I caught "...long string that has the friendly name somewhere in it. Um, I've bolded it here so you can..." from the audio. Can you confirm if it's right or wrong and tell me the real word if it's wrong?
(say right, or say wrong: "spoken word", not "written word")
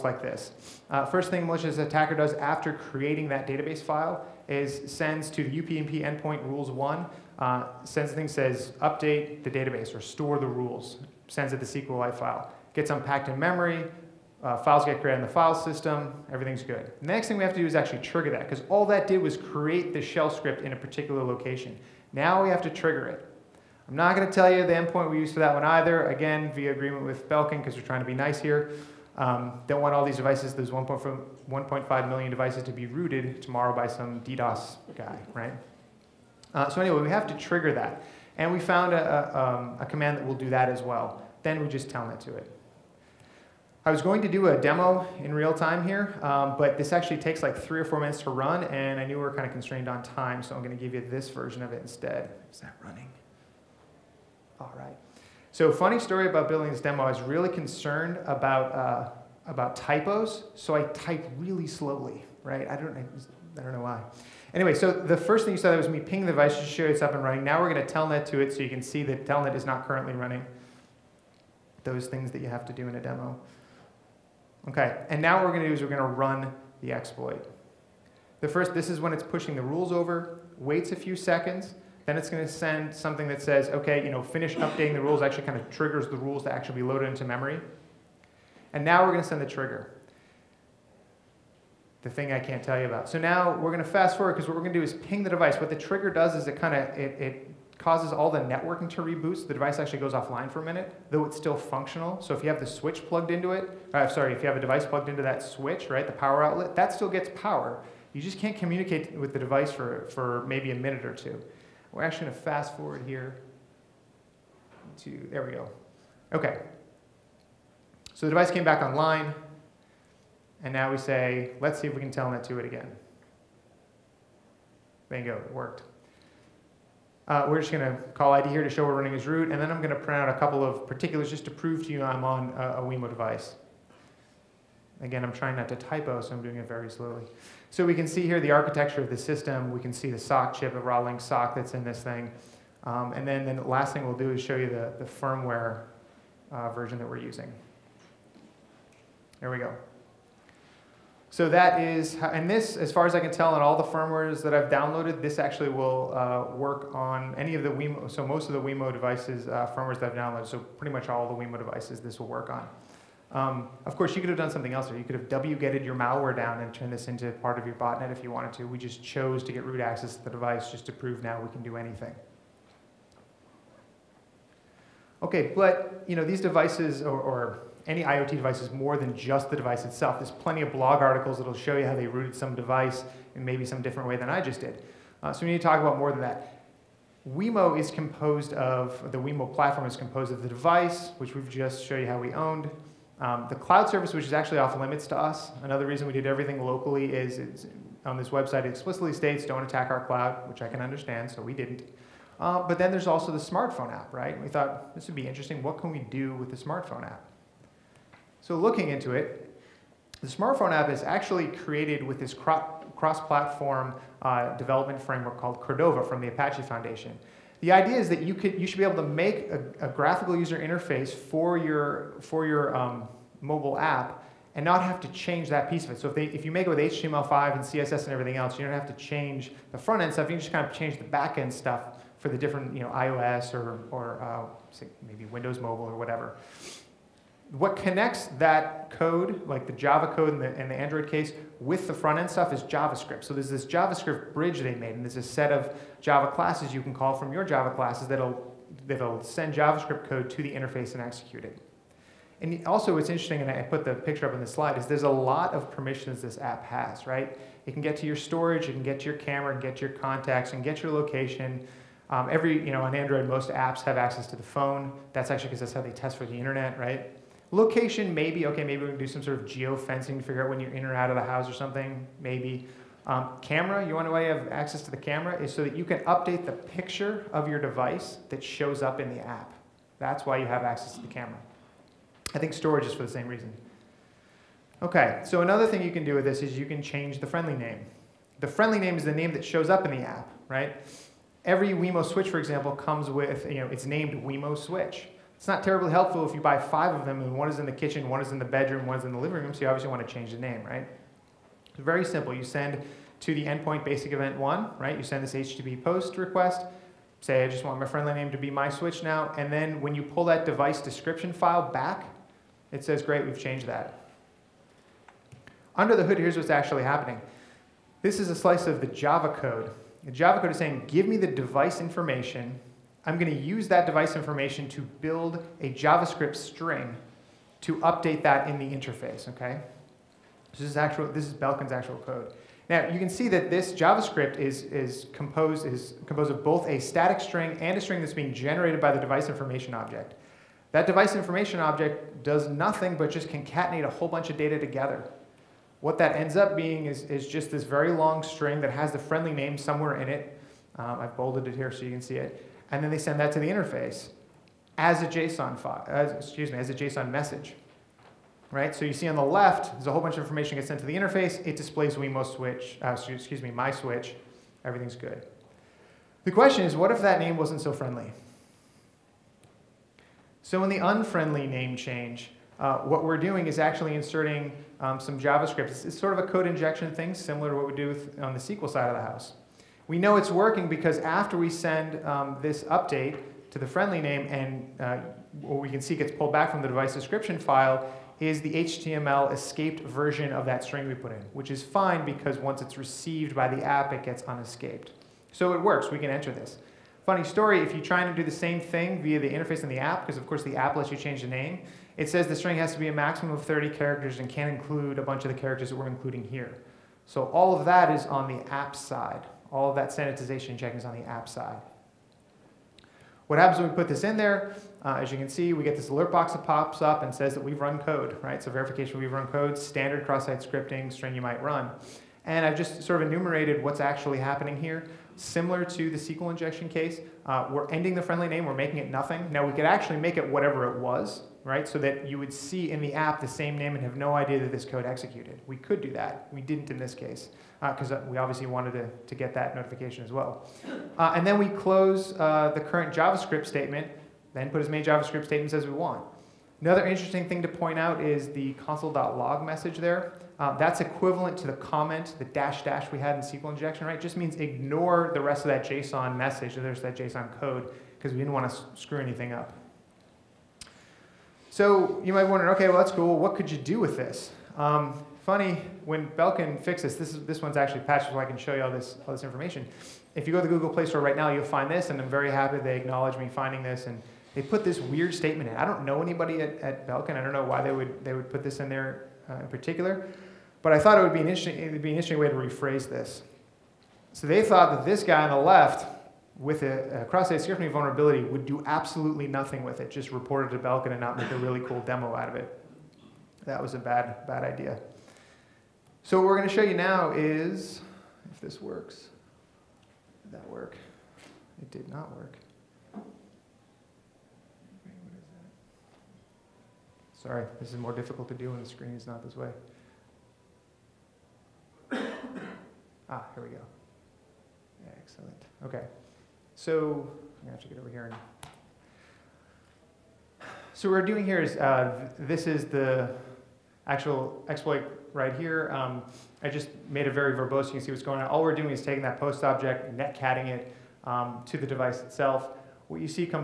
right.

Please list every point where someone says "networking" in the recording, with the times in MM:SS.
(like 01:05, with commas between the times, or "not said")
01:38.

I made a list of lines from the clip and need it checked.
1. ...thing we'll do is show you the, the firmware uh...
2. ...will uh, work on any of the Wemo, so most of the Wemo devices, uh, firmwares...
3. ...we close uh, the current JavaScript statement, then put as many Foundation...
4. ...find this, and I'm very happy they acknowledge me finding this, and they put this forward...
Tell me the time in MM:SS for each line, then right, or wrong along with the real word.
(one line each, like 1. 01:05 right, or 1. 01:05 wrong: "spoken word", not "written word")
1. 02:23 right
2. 02:35 right
3. 07:21 wrong: "JavaScript", not "Foundation"
4. 07:51 wrong: "weird", not "forward".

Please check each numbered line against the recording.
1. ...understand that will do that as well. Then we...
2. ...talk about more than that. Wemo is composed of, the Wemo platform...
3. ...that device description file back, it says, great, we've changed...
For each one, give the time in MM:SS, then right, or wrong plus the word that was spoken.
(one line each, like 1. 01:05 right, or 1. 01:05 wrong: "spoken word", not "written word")
1. 00:39 wrong: "command", not "understand"
2. 03:05 right
3. 05:10 right.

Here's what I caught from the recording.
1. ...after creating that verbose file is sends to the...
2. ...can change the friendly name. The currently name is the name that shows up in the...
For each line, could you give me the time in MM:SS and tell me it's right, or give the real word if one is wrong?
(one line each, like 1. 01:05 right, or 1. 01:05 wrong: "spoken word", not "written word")
1. 00:02 wrong: "database", not "verbose"
2. 04:46 wrong: "friendly", not "currently".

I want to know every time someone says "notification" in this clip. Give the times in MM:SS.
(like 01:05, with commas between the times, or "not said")
07:19.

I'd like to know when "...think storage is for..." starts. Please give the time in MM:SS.
04:42.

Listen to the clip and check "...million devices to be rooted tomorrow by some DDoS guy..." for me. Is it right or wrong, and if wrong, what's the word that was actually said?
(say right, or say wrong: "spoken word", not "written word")
right.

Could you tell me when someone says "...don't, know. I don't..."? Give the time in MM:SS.
01:02.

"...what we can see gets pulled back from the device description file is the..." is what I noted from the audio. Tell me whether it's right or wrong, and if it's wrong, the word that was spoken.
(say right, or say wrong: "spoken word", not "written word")
right.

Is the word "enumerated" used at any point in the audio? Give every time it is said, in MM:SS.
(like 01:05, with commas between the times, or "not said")
07:03.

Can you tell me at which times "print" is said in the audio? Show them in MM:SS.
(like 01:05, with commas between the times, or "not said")
02:09.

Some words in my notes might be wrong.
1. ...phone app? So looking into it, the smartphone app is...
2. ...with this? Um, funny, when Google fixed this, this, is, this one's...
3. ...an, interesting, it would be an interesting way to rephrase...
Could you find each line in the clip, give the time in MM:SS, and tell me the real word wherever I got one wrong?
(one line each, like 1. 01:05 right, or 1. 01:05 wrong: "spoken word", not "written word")
1. 03:26 wrong: "smartphone", not "phone"
2. 07:43 wrong: "Belkin", not "Google"
3. 08:01 right.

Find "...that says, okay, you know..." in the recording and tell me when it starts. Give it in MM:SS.
01:23.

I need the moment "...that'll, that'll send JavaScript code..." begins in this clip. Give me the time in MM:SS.
04:08.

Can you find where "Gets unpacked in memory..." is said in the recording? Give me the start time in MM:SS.
00:12.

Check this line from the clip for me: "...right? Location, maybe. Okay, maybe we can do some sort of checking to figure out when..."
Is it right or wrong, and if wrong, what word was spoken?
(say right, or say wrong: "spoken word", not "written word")
wrong: "geofencing", not "checking".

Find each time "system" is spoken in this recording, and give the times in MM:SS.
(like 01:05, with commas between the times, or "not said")
00:15, 02:19.